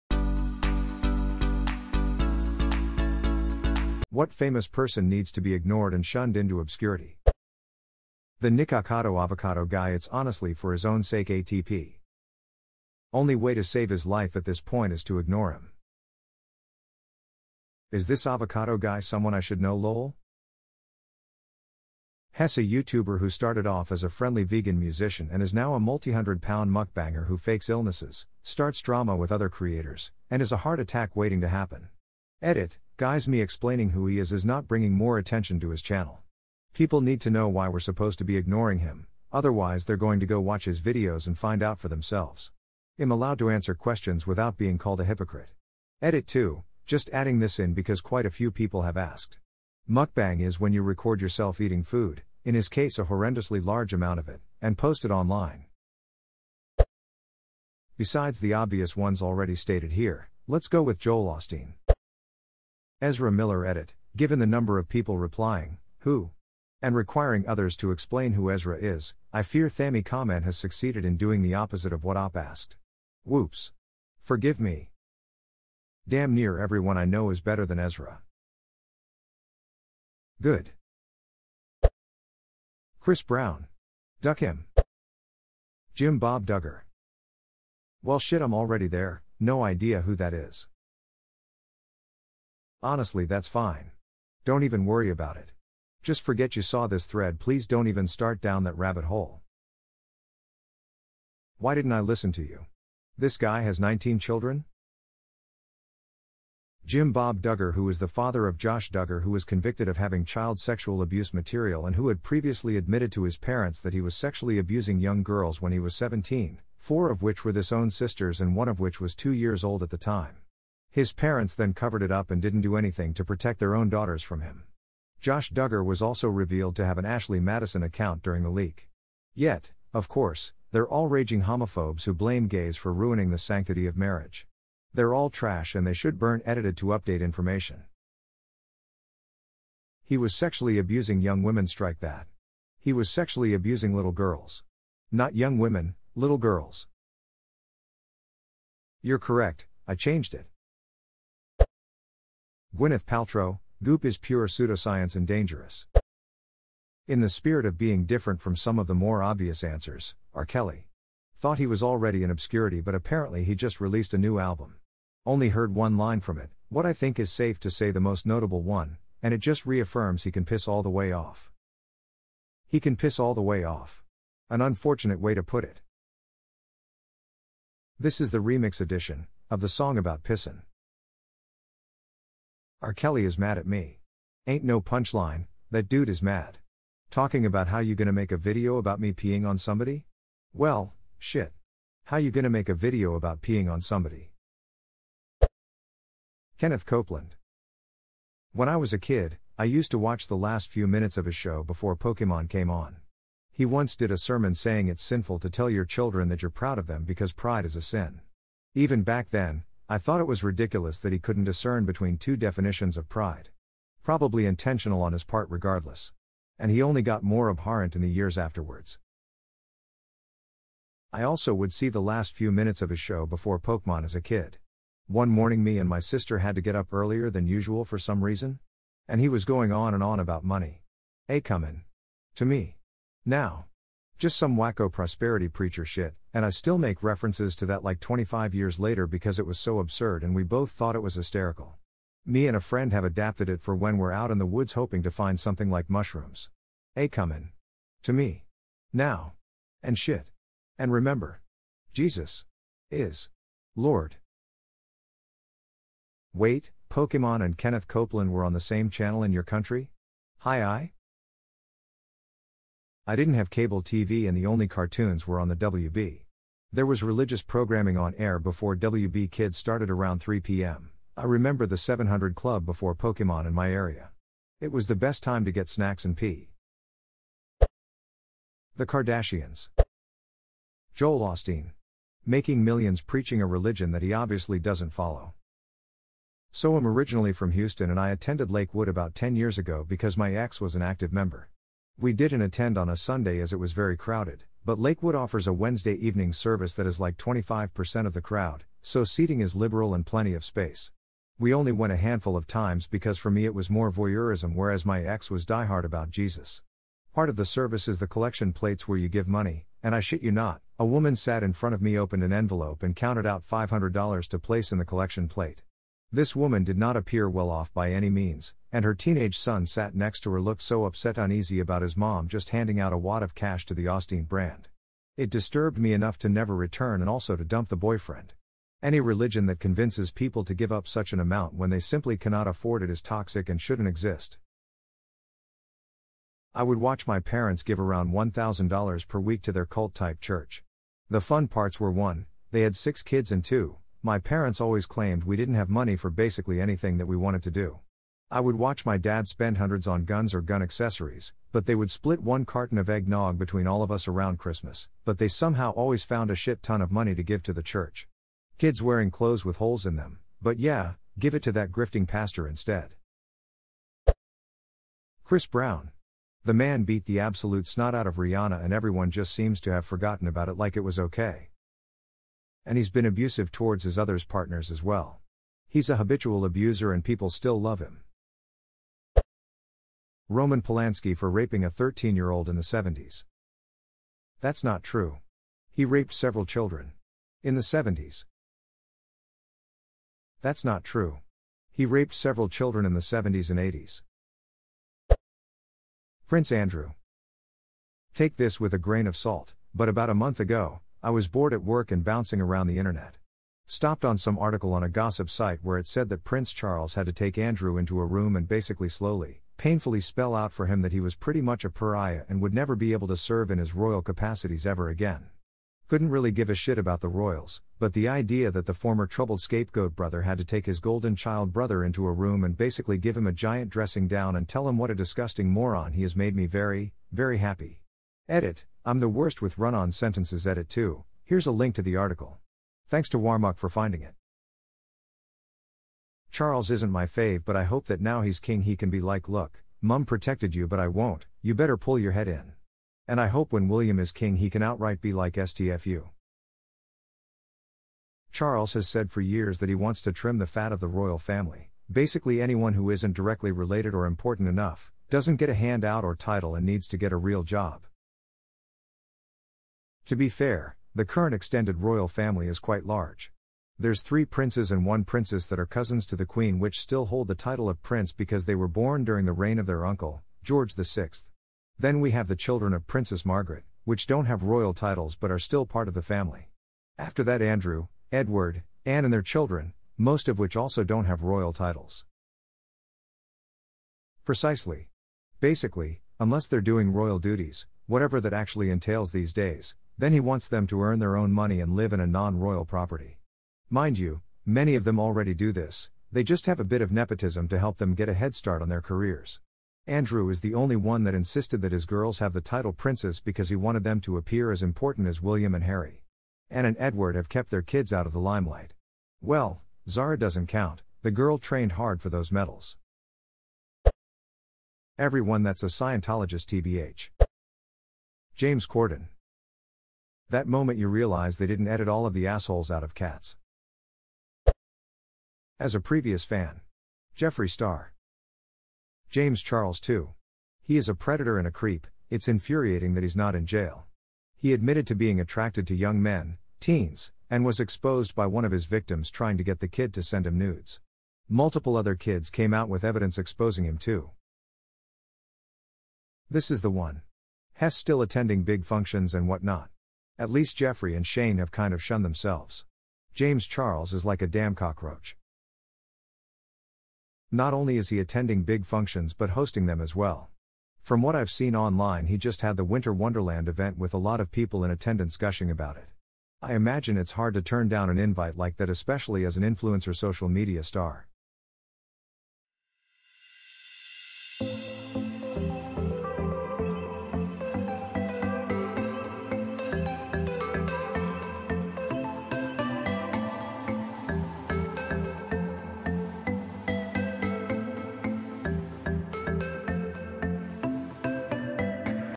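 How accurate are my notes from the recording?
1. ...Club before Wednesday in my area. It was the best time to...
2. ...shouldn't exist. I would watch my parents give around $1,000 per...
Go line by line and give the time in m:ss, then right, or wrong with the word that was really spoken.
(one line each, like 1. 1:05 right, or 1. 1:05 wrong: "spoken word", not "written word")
1. 4:32 wrong: "Pokemon", not "Wednesday"
2. 5:33 right.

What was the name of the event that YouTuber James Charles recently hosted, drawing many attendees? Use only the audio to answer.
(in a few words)
Winter Wonderland.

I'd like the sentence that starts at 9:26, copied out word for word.
I imagine it's hard to turn down an invite like that, especially as an influencer social media star.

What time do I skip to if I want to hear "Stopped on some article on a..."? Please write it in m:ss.
6:43.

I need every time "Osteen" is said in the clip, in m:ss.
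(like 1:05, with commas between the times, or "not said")
1:01, 4:41, 5:23.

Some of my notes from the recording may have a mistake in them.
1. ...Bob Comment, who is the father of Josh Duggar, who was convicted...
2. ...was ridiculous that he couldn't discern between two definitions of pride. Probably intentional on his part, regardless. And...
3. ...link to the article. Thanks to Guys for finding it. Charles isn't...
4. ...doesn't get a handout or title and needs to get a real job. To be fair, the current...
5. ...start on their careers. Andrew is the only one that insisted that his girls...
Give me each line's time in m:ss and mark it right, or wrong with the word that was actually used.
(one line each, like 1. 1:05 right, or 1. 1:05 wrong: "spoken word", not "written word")
1. 1:47 wrong: "Duggar", not "Comment"
2. 3:30 right
3. 7:11 wrong: "Warmuck", not "Guys"
4. 7:35 right
5. 8:18 right.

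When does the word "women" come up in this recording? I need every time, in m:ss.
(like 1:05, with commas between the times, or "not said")
2:21, 2:25.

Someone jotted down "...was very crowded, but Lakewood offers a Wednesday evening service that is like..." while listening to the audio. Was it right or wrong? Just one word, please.
right.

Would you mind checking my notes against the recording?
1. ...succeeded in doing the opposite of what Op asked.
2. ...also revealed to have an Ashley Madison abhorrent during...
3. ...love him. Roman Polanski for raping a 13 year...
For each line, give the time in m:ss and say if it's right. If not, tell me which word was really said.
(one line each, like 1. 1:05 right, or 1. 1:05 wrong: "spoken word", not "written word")
1. 1:10 right
2. 2:06 wrong: "account", not "abhorrent"
3. 6:17 right.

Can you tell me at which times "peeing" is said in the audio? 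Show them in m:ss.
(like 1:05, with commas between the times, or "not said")
3:09, 3:13.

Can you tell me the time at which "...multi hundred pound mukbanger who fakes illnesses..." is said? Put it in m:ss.
0:25.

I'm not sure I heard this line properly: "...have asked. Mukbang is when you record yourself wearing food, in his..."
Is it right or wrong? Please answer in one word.
wrong.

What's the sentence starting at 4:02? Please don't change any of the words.
Me and a friend have adapted it for when we're out in the woods hoping to find something like mushrooms.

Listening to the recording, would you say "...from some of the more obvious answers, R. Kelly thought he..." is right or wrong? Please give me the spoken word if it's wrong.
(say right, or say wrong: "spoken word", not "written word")
right.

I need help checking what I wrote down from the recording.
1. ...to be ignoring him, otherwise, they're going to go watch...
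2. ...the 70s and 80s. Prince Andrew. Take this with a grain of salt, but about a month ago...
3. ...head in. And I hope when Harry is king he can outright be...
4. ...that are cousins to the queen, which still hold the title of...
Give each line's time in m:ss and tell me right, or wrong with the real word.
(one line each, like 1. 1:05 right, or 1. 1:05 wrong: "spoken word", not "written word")
1. 0:38 right
2. 6:32 right
3. 7:22 wrong: "William", not "Harry"
4. 7:45 right.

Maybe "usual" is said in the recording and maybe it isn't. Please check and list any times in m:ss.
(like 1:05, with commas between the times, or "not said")
3:47.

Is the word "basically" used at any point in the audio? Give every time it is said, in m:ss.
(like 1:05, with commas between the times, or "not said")
5:46, 6:48, 7:02, 7:31, 8:05.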